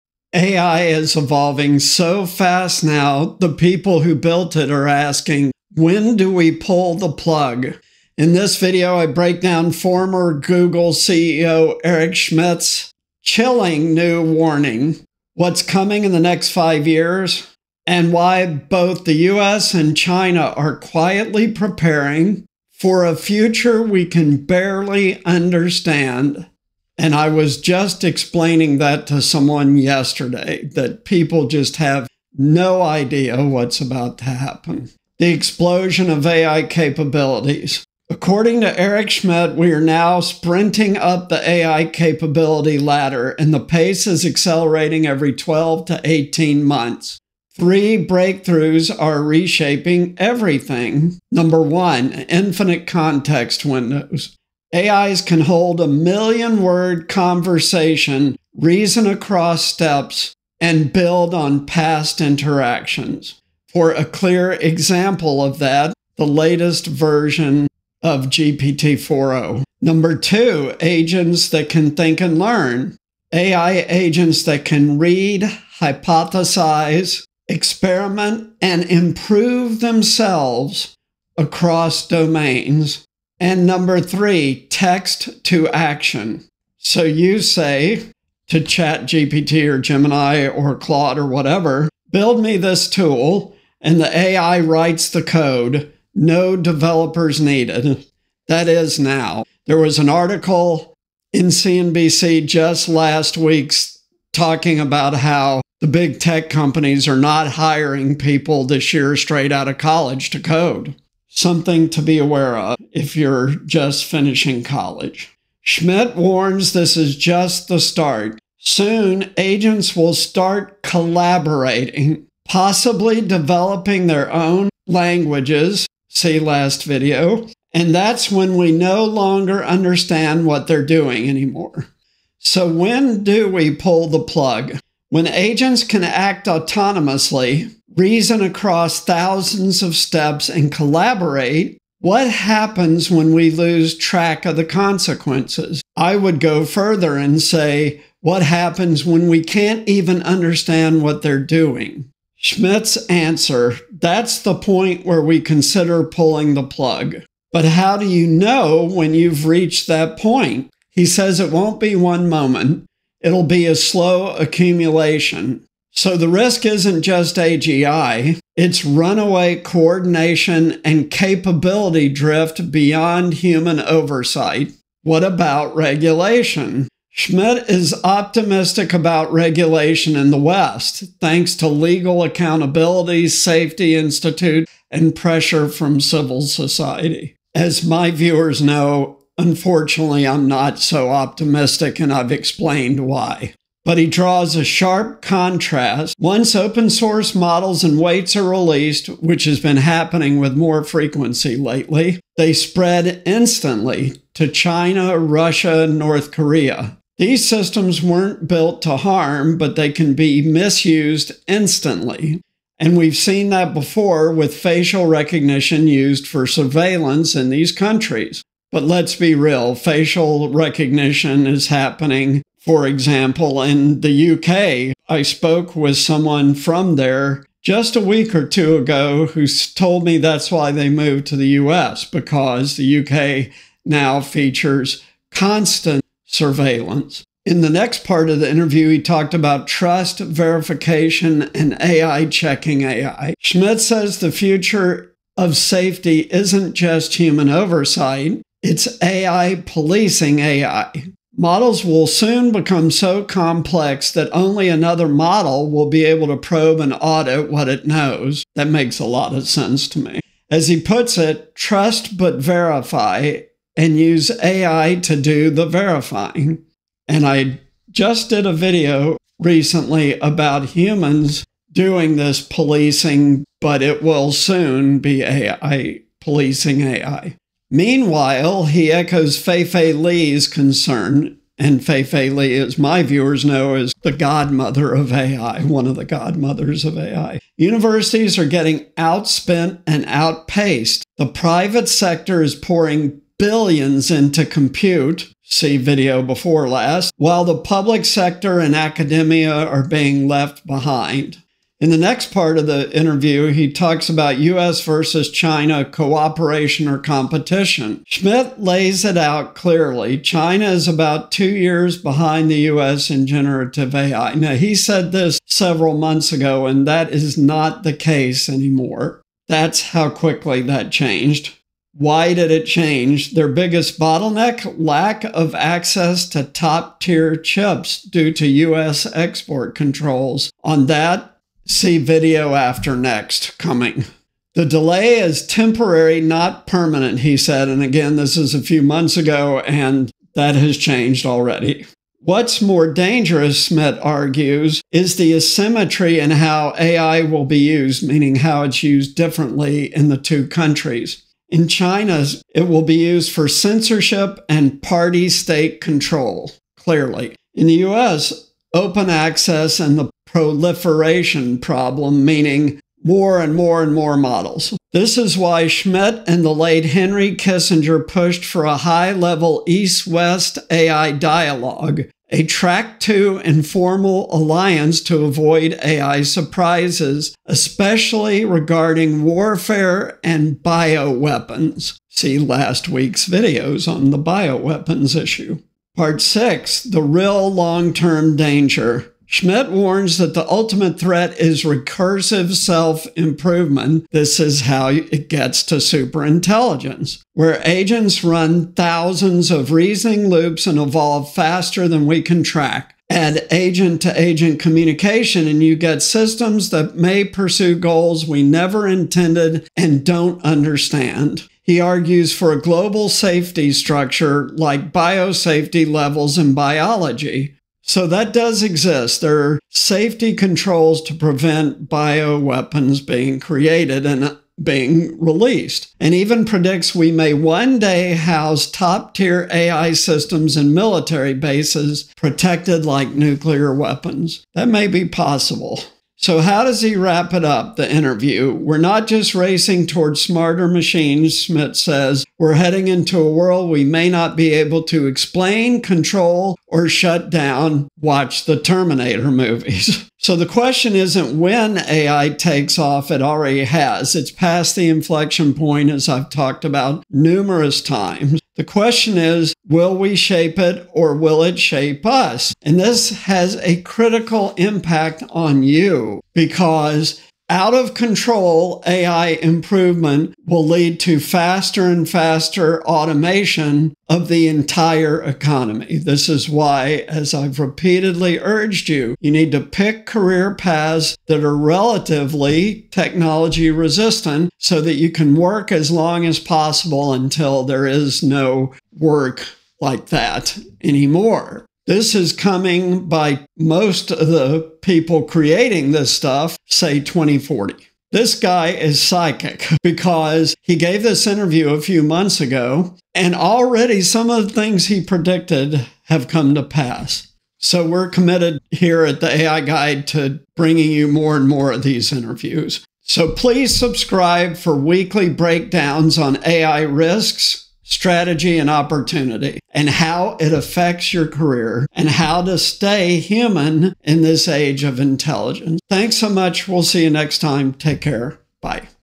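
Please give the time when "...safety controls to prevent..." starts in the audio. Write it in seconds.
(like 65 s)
419 s.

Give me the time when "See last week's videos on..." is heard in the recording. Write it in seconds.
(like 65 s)
382 s.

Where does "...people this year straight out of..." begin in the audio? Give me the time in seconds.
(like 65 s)
108 s.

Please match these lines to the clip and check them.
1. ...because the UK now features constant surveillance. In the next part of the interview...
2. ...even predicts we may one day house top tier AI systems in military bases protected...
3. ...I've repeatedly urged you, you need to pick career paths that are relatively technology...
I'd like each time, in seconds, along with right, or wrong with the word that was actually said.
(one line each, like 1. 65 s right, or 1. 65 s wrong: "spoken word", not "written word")
1. 232 s right
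2. 426 s right
3. 477 s right.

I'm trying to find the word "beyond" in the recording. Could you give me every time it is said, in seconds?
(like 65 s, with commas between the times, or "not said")
172 s.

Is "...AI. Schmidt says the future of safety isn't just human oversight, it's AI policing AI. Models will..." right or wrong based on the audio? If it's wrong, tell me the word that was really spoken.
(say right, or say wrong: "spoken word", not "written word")
right.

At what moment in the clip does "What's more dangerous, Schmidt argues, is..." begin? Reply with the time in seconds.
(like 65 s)
342 s.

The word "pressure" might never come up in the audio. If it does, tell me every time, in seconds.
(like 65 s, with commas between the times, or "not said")
185 s.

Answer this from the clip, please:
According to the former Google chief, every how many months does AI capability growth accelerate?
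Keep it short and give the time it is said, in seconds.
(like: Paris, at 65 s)
12 to 18 months, at 45 s.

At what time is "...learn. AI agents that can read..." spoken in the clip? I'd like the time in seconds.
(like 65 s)
72 s.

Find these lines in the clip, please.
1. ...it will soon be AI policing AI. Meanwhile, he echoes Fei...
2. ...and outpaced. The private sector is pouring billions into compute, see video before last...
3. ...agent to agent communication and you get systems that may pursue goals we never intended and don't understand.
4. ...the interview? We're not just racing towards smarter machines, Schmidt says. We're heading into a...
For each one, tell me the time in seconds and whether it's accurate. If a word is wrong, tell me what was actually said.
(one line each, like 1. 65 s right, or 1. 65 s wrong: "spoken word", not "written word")
1. 273 s right
2. 289 s right
3. 403 s right
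4. 437 s right.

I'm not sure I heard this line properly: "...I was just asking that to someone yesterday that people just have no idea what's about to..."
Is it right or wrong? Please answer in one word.
wrong.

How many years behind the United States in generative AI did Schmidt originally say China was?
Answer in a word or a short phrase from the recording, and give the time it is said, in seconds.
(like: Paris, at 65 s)
2 years, at 311 s.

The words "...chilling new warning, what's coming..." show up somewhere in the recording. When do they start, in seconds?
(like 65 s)
13 s.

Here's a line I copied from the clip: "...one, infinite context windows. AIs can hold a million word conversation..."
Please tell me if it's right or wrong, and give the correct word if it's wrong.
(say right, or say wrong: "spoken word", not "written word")
right.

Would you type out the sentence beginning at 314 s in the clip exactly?
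Now, he said this several months ago, and that is not the case anymore.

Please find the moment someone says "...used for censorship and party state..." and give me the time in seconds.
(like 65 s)
352 s.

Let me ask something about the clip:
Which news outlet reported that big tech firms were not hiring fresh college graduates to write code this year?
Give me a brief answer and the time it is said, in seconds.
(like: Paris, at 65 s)
CNBC, at 101 s.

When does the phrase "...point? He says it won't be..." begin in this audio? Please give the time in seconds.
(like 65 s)
160 s.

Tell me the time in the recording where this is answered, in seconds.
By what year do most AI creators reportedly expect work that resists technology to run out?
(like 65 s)
496 s.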